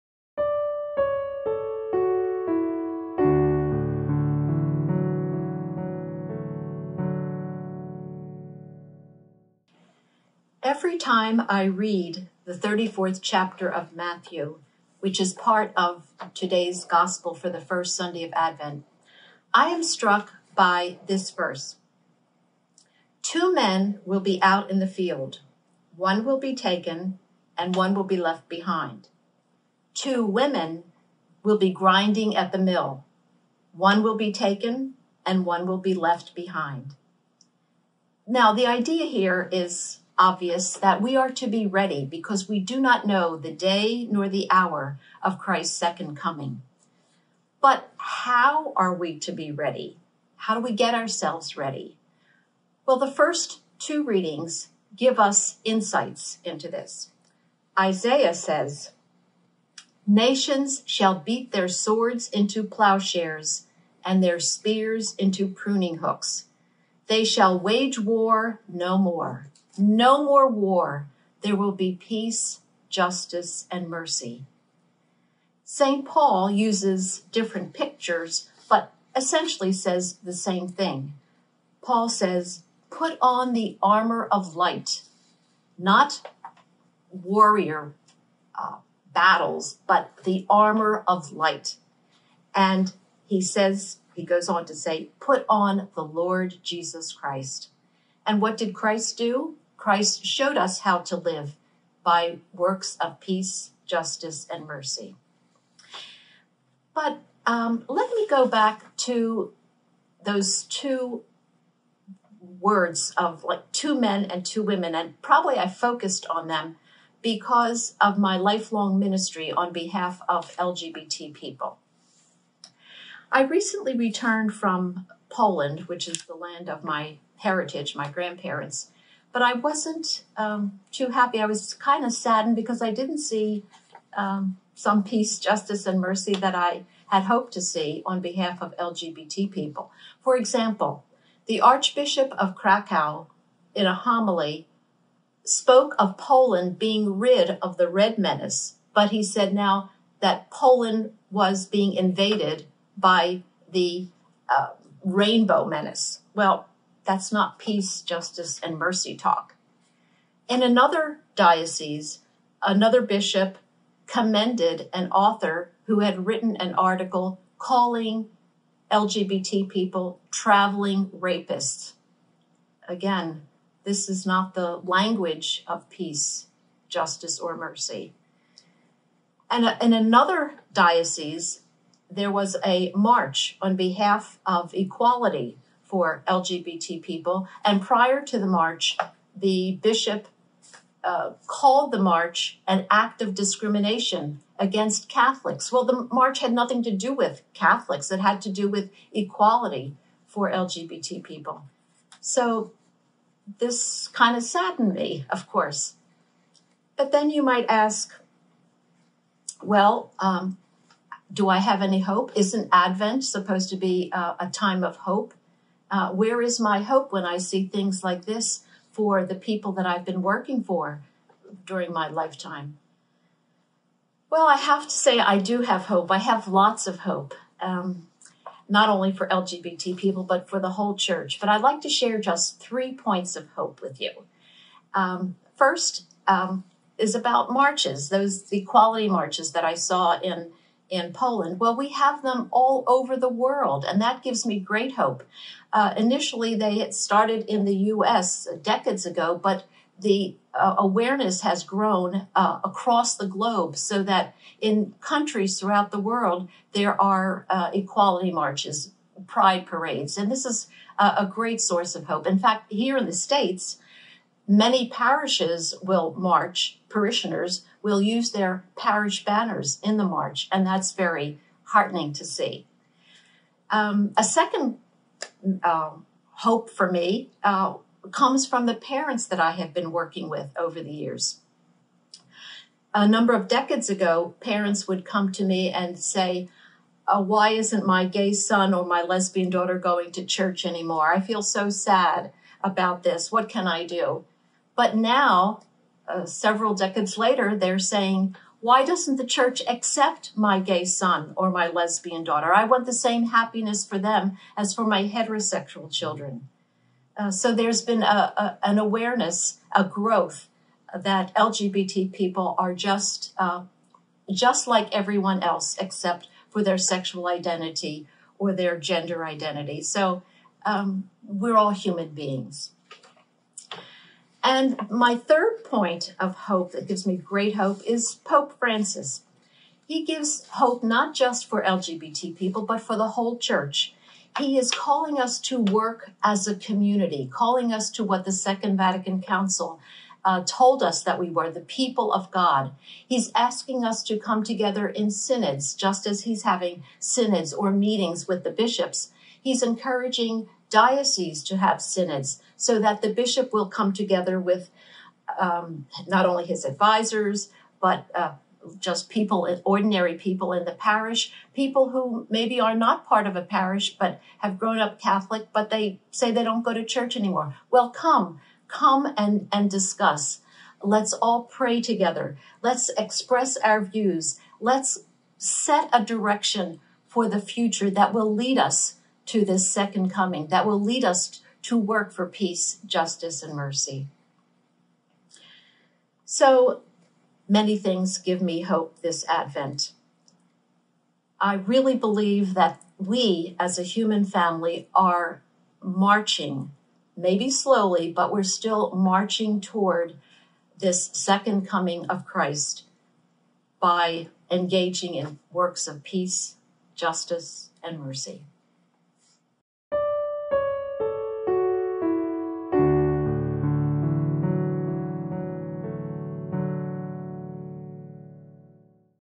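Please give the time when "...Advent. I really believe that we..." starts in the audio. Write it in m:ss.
6:29.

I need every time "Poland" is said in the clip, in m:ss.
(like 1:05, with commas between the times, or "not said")
2:05, 2:26, 2:30, 4:01.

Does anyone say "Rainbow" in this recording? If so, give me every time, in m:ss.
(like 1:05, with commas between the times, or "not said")
2:35.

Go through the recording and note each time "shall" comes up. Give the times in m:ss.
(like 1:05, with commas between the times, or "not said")
1:00, 1:07.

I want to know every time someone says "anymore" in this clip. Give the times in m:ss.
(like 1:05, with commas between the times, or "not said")
4:50, 6:07.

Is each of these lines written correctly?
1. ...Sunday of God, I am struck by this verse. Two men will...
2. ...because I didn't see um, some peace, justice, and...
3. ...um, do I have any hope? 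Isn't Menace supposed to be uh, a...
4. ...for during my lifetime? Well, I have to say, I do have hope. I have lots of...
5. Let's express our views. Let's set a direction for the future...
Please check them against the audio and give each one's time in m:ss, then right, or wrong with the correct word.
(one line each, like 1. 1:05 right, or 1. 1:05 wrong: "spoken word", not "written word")
1. 0:17 wrong: "Advent", not "God"
2. 2:12 right
3. 3:30 wrong: "Advent", not "Menace"
4. 3:40 right
5. 6:12 right.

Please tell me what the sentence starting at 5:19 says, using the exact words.
So um, we're all human beings.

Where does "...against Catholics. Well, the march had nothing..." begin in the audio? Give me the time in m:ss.
3:14.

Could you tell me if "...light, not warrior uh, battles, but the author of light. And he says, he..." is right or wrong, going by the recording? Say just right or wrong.
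wrong.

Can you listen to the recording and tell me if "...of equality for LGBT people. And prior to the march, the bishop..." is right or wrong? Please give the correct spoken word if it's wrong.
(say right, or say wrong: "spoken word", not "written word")
right.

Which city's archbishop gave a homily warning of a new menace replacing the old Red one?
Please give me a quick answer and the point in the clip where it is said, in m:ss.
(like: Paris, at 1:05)
Krakow, at 2:22.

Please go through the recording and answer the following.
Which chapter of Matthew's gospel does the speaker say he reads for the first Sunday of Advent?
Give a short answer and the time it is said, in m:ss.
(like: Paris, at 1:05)
34th, at 0:12.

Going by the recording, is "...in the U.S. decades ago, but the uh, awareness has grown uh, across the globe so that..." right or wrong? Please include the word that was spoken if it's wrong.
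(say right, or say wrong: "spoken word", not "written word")
right.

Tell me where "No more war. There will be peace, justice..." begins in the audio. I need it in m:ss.
1:09.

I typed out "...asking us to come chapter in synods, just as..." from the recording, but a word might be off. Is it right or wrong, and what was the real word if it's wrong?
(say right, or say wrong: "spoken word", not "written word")
wrong: "together", not "chapter".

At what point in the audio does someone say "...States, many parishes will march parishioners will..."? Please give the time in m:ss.
4:23.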